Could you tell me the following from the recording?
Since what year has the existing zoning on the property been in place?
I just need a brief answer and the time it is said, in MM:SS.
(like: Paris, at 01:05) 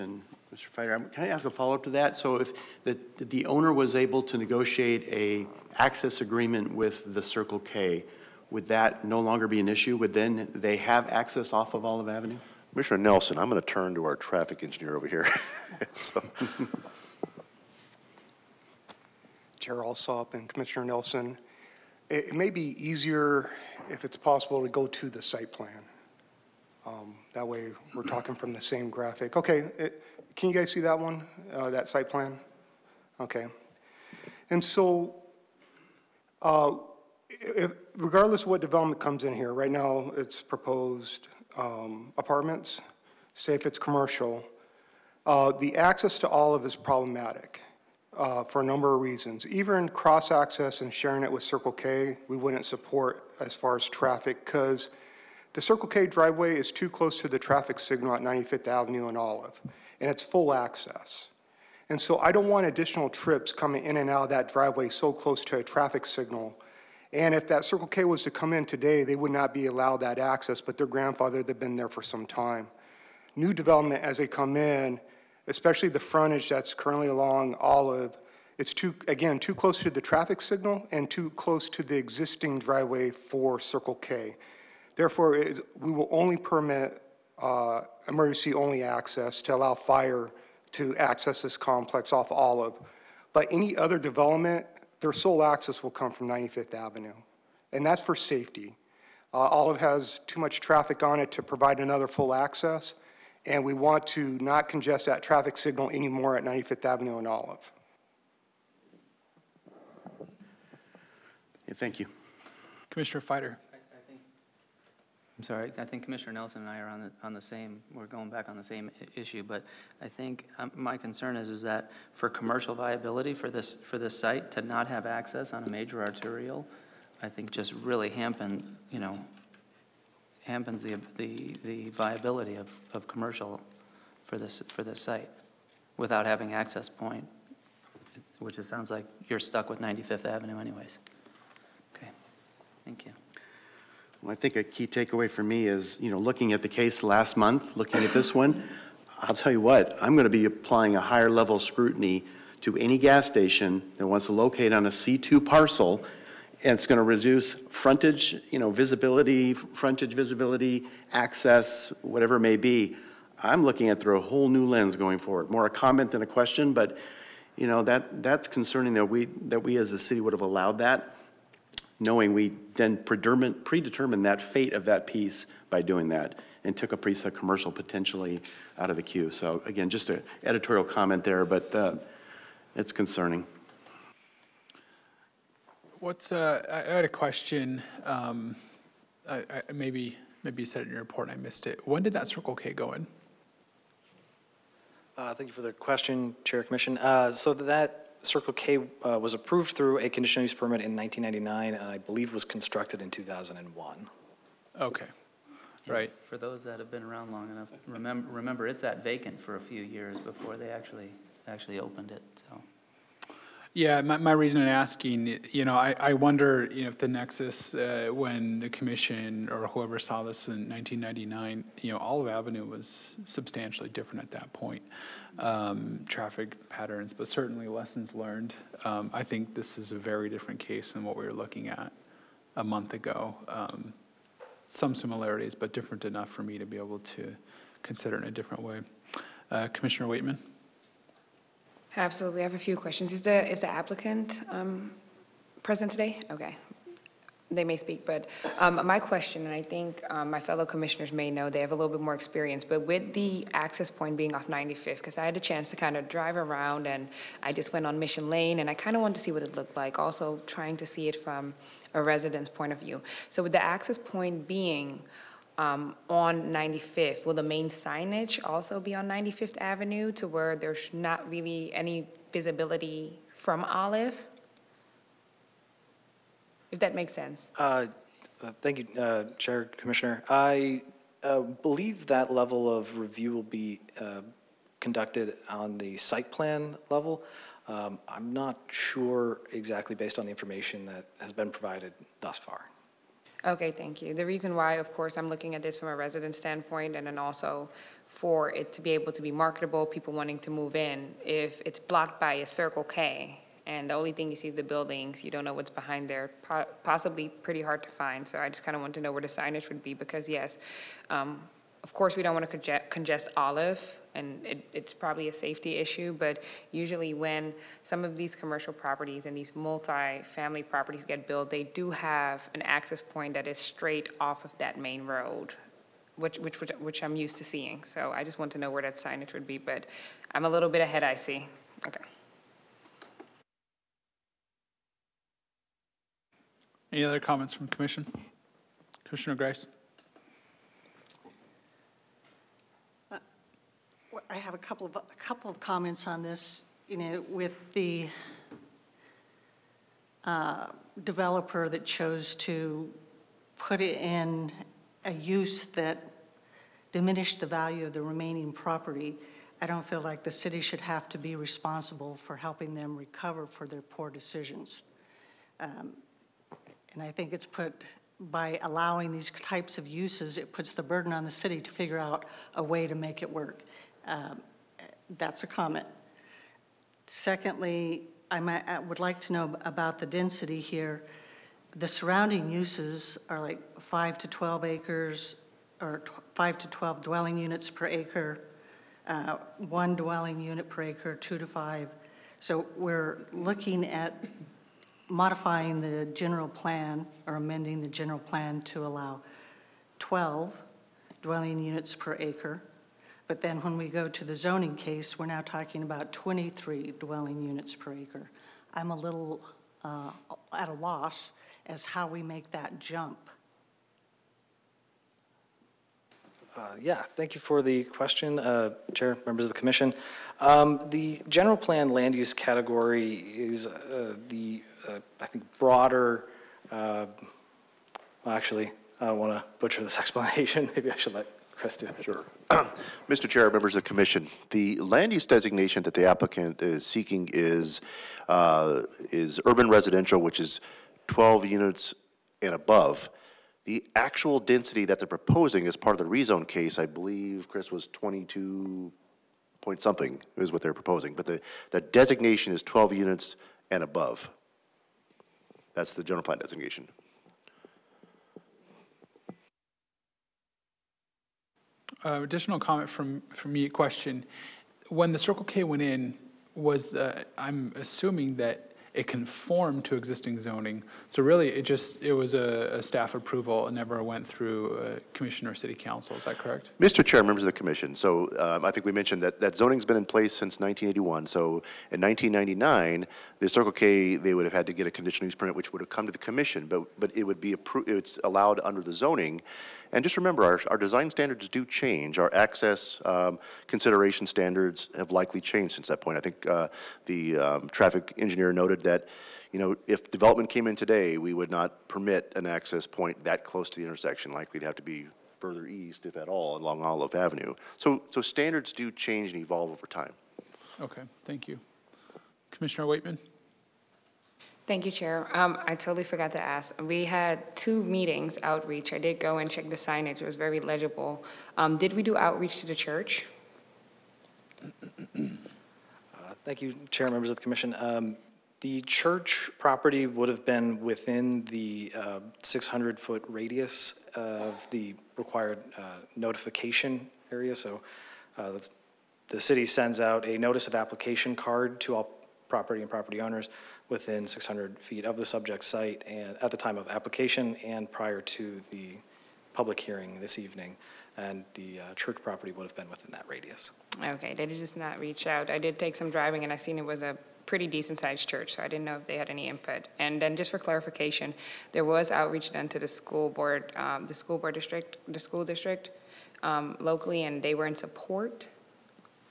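1981, at 08:00.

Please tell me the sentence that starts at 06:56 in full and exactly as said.
Uh, yeah, thank you for the question, uh, Chair, members of the Commission.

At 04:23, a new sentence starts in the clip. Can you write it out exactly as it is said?
So with the access point being um, on 95th?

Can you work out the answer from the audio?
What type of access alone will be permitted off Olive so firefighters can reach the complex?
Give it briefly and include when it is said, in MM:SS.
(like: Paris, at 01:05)
emergency-only access, at 01:28.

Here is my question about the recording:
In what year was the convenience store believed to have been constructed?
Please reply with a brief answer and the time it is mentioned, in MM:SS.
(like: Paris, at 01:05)
2001, at 03:23.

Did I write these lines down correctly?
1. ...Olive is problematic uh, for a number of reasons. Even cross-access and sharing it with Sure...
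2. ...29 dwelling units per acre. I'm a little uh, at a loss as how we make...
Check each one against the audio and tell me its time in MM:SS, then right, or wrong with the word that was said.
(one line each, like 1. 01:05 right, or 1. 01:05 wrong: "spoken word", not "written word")
1. 00:46 wrong: "Circle", not "Sure"
2. 06:46 wrong: "23", not "29".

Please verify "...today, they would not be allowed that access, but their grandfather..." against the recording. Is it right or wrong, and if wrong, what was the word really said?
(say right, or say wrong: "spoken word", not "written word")
right.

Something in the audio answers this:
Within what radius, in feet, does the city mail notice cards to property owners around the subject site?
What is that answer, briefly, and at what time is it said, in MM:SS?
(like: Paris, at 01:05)
600 feet, at 08:52.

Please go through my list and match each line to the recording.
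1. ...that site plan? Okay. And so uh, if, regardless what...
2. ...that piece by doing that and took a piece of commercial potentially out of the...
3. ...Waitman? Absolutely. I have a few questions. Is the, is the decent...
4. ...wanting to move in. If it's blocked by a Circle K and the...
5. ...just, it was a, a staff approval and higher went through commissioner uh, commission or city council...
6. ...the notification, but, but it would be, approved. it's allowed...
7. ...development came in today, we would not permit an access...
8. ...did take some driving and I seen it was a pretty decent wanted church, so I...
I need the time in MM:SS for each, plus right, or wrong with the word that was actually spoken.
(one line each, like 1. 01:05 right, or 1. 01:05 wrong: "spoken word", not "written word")
1. 00:31 right
2. 02:54 right
3. 04:00 wrong: "applicant", not "decent"
4. 05:00 right
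5. 07:51 wrong: "never", not "higher"
6. 08:06 wrong: "commission", not "notification"
7. 08:20 right
8. 09:15 wrong: "sized", not "wanted".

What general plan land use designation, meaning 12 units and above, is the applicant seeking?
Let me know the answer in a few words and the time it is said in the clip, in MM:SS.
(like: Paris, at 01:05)
urban residential, at 07:19.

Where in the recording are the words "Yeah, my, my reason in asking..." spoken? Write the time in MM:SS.
03:33.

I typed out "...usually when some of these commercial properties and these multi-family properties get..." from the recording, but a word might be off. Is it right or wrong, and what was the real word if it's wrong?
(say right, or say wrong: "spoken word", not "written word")
right.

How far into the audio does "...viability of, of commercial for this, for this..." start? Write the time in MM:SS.
02:11.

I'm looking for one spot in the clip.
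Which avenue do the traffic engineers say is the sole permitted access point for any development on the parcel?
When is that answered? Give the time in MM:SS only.
01:34.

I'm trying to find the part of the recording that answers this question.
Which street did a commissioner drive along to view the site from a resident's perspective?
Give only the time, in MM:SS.
04:17.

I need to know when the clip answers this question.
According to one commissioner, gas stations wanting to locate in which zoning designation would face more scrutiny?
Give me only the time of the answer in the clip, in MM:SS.
02:34.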